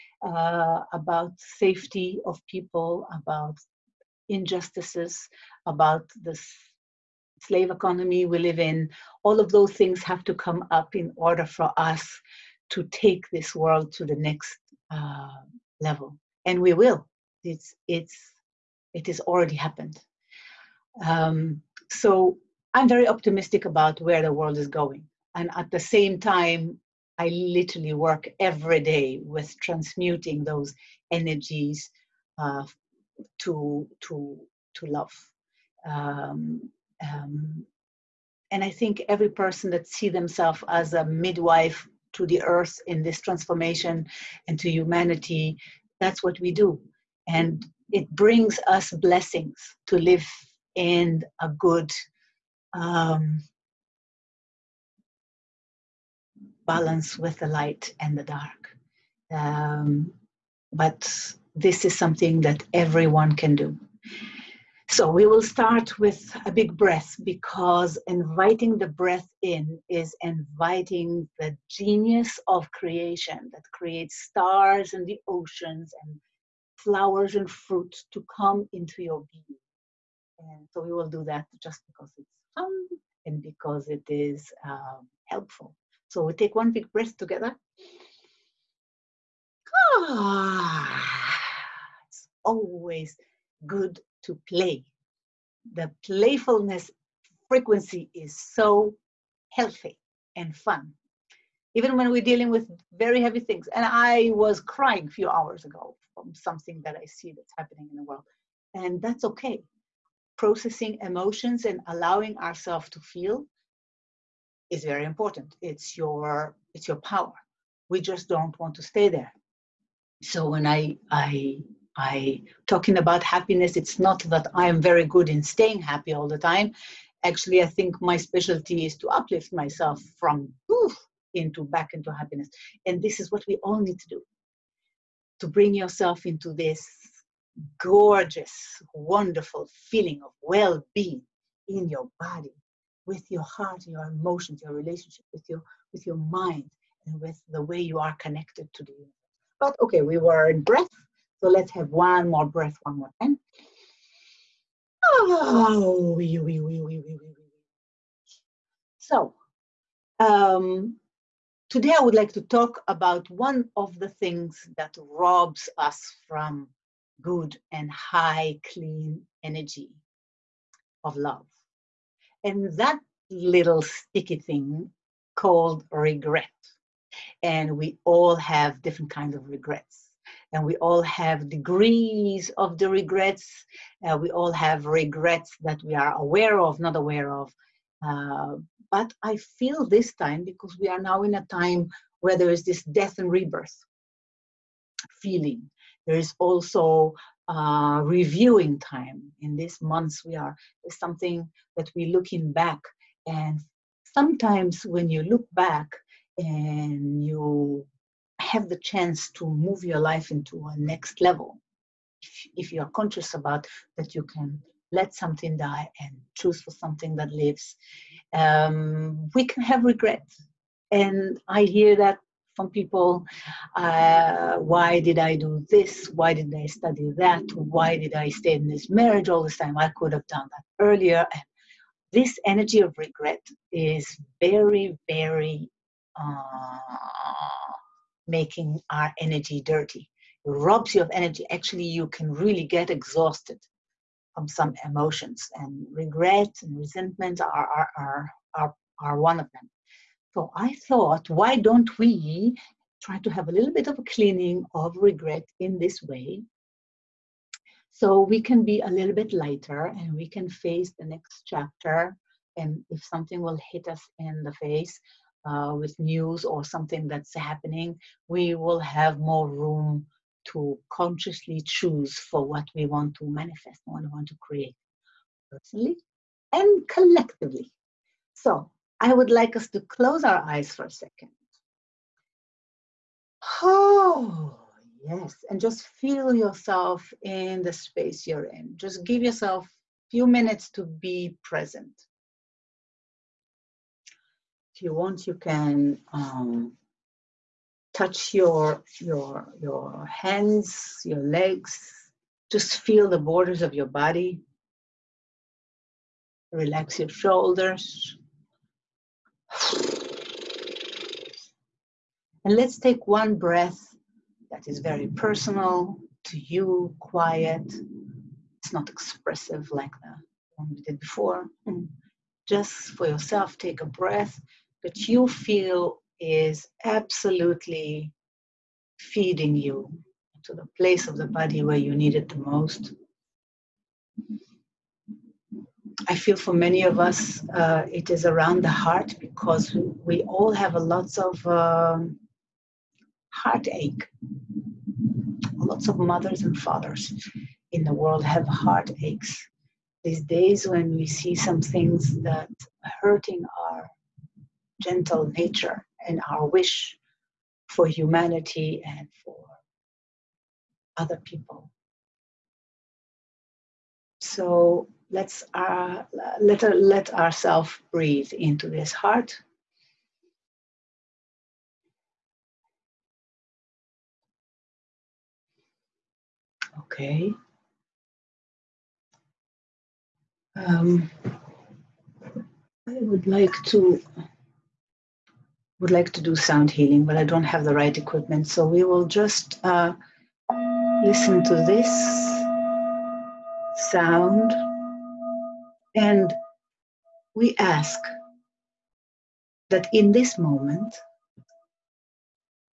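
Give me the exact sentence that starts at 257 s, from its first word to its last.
So we can be a little bit lighter and we can face the next chapter.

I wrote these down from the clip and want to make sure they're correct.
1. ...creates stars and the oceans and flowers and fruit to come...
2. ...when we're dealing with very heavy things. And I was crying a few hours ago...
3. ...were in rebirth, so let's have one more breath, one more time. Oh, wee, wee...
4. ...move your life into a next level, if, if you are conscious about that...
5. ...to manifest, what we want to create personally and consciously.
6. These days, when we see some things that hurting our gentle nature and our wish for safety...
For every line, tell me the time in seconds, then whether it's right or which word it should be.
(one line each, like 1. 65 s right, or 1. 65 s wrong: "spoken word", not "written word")
1. 73 s right
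2. 101 s right
3. 150 s wrong: "breath", not "rebirth"
4. 209 s right
5. 273 s wrong: "collectively", not "consciously"
6. 350 s wrong: "humanity", not "safety".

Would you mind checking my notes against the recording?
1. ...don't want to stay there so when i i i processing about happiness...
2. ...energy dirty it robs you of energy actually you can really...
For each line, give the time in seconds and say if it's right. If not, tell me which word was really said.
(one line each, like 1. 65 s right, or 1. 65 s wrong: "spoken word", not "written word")
1. 118 s wrong: "talking", not "processing"
2. 239 s right.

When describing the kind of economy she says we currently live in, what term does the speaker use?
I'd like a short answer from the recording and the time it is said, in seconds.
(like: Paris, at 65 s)
slave economy, at 7 s.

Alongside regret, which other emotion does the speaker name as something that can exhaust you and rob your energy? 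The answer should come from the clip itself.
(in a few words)
resentment.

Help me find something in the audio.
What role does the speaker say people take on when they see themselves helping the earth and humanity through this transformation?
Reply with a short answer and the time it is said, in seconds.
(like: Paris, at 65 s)
midwife, at 41 s.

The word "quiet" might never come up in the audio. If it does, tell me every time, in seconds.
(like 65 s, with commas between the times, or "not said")
316 s.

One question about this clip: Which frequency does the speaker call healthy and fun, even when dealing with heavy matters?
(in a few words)
playfulness.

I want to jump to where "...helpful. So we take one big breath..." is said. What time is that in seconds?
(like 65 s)
85 s.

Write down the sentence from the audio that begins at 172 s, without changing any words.
And that little sticky thing called regret.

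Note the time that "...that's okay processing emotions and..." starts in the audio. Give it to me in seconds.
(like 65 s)
109 s.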